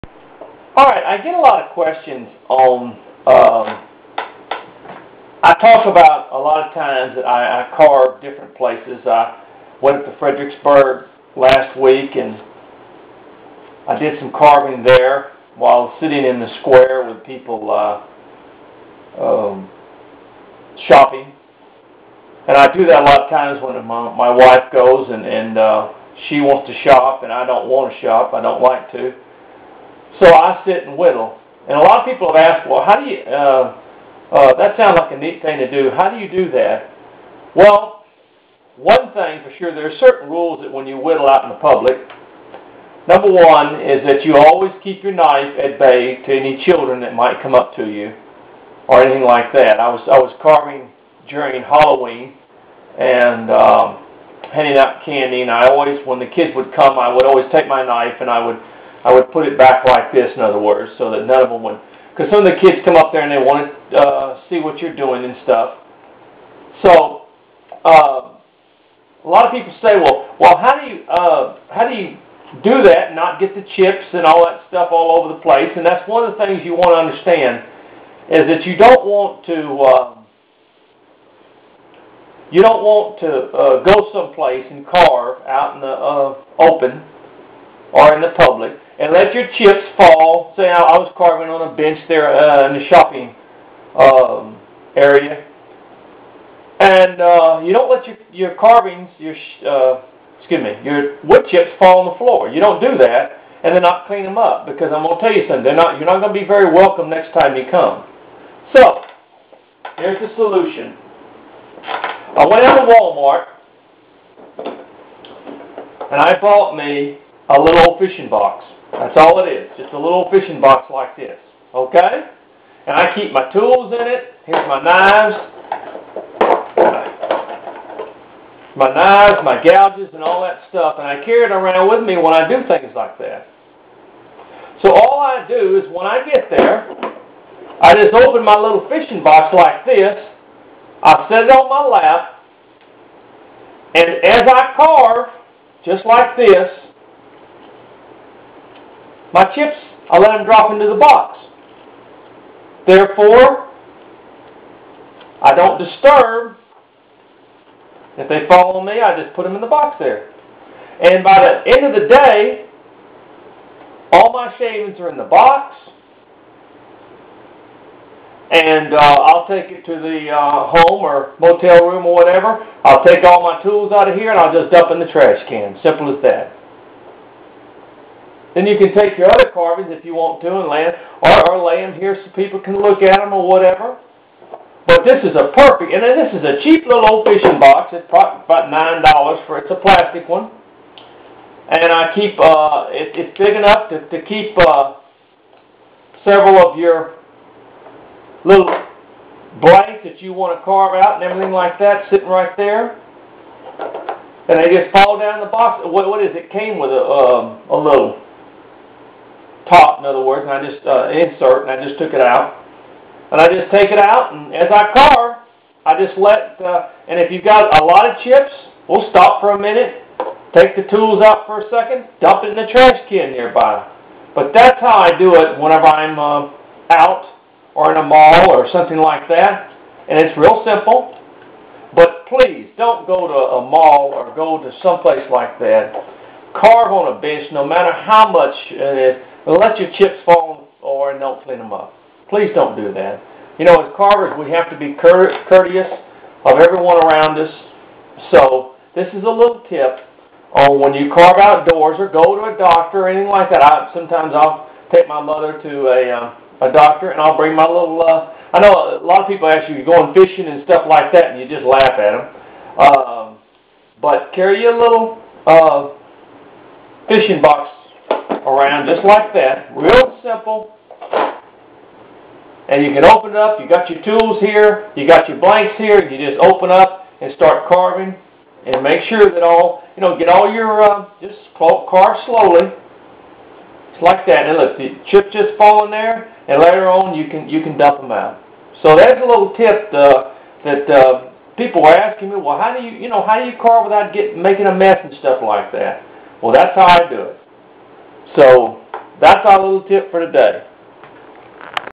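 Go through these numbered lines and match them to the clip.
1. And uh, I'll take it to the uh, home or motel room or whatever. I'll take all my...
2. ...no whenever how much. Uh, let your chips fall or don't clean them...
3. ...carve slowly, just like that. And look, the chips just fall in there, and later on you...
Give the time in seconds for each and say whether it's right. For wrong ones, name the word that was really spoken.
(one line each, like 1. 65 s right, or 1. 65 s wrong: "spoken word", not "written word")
1. 168 s right
2. 237 s wrong: "matter", not "whenever"
3. 281 s right.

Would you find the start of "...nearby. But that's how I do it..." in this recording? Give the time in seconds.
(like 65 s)
223 s.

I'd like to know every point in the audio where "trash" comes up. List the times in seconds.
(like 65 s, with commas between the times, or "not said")
175 s, 222 s.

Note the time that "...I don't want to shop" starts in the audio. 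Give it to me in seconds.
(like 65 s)
27 s.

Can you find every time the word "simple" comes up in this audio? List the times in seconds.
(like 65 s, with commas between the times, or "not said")
175 s, 230 s, 270 s.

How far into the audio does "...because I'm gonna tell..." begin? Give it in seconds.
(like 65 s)
104 s.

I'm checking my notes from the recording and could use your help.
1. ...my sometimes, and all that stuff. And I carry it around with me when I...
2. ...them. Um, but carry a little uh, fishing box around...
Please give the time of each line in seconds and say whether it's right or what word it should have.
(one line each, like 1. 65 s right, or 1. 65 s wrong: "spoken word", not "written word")
1. 129 s wrong: "gouges", not "sometimes"
2. 261 s right.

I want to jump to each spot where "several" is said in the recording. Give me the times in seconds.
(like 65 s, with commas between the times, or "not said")
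196 s.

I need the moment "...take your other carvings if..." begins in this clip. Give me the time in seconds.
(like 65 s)
178 s.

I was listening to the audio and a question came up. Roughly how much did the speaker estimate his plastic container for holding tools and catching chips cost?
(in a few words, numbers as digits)
$9.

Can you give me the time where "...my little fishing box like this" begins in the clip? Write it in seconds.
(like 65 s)
138 s.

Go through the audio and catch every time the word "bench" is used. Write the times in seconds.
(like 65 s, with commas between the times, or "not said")
91 s, 237 s.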